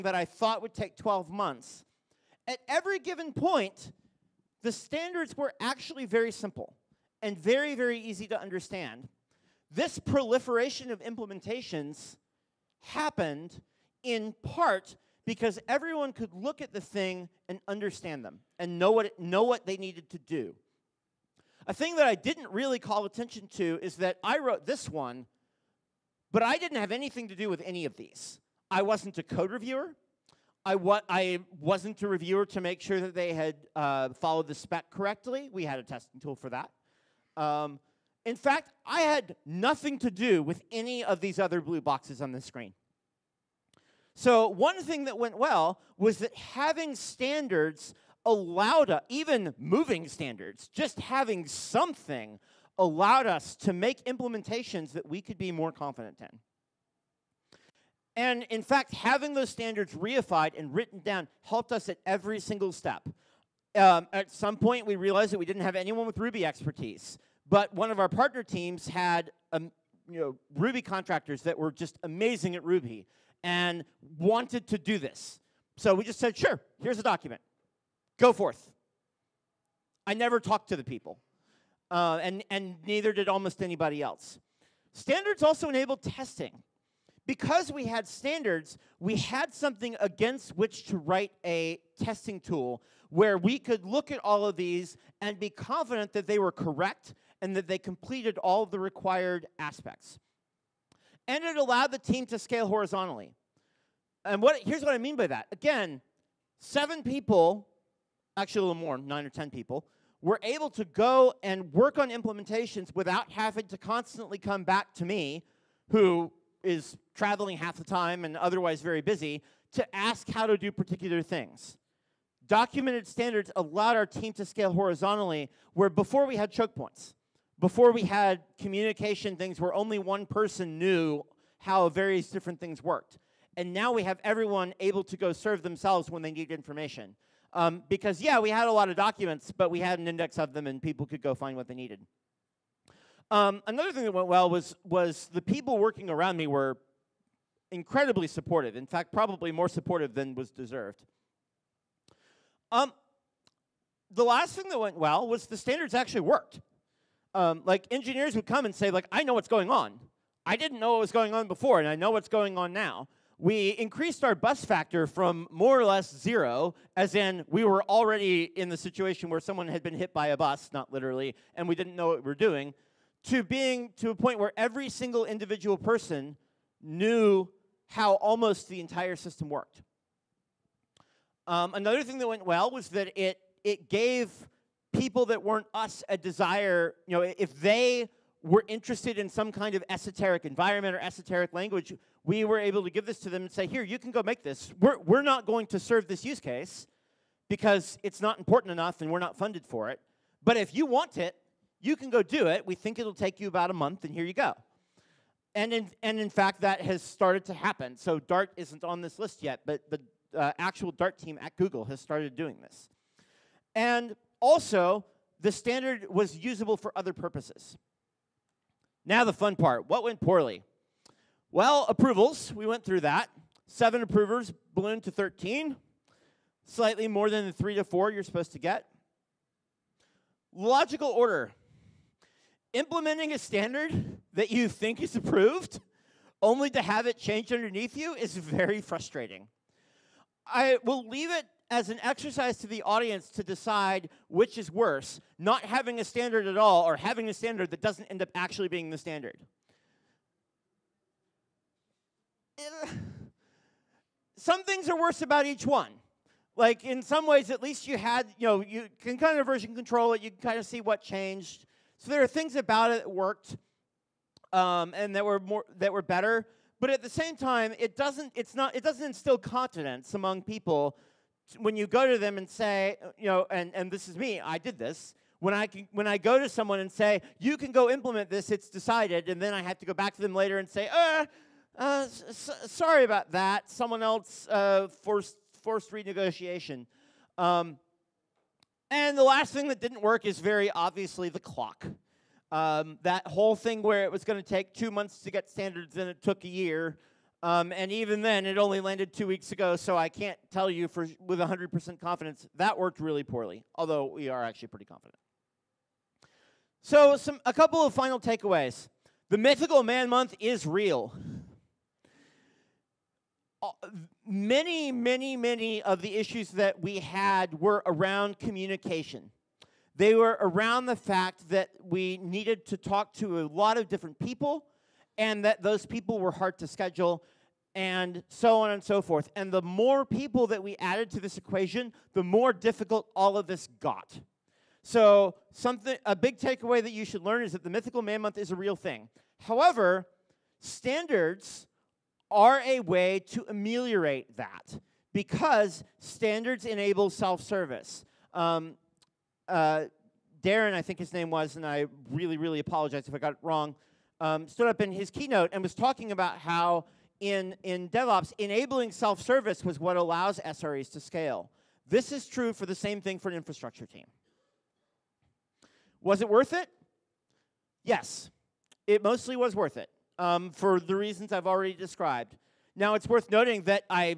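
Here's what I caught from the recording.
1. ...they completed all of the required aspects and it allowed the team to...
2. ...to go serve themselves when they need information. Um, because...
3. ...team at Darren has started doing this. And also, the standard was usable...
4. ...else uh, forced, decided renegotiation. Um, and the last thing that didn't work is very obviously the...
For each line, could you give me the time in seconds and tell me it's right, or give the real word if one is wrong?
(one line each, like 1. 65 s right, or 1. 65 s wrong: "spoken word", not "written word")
1. 97 s right
2. 135 s right
3. 211 s wrong: "Google", not "Darren"
4. 284 s wrong: "forced", not "decided".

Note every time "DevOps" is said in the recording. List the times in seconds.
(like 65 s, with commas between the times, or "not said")
357 s.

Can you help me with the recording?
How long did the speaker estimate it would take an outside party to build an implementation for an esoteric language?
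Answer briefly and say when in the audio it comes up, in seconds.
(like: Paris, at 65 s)
About a month, at 203 s.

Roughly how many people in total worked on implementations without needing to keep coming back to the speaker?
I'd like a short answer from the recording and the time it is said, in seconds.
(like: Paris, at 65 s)
9 or 10, at 108 s.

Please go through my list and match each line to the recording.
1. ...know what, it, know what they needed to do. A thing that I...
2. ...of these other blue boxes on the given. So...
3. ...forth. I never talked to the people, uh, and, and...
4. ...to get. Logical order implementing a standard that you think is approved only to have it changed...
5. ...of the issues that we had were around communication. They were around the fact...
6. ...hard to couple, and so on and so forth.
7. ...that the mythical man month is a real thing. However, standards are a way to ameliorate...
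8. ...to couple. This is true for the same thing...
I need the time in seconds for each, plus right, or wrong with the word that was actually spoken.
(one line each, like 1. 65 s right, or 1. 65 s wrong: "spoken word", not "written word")
1. 18 s right
2. 41 s wrong: "screen", not "given"
3. 78 s right
4. 228 s right
5. 315 s right
6. 326 s wrong: "schedule", not "couple"
7. 337 s right
8. 360 s wrong: "scale", not "couple".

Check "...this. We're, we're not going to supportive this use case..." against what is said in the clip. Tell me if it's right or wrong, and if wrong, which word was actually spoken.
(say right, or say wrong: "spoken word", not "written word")
wrong: "serve", not "supportive".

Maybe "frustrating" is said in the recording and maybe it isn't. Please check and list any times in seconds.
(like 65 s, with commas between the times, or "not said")
238 s.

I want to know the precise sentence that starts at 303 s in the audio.
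Although we are actually pretty confident.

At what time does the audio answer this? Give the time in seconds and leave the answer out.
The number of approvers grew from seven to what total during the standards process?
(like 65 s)
225 s.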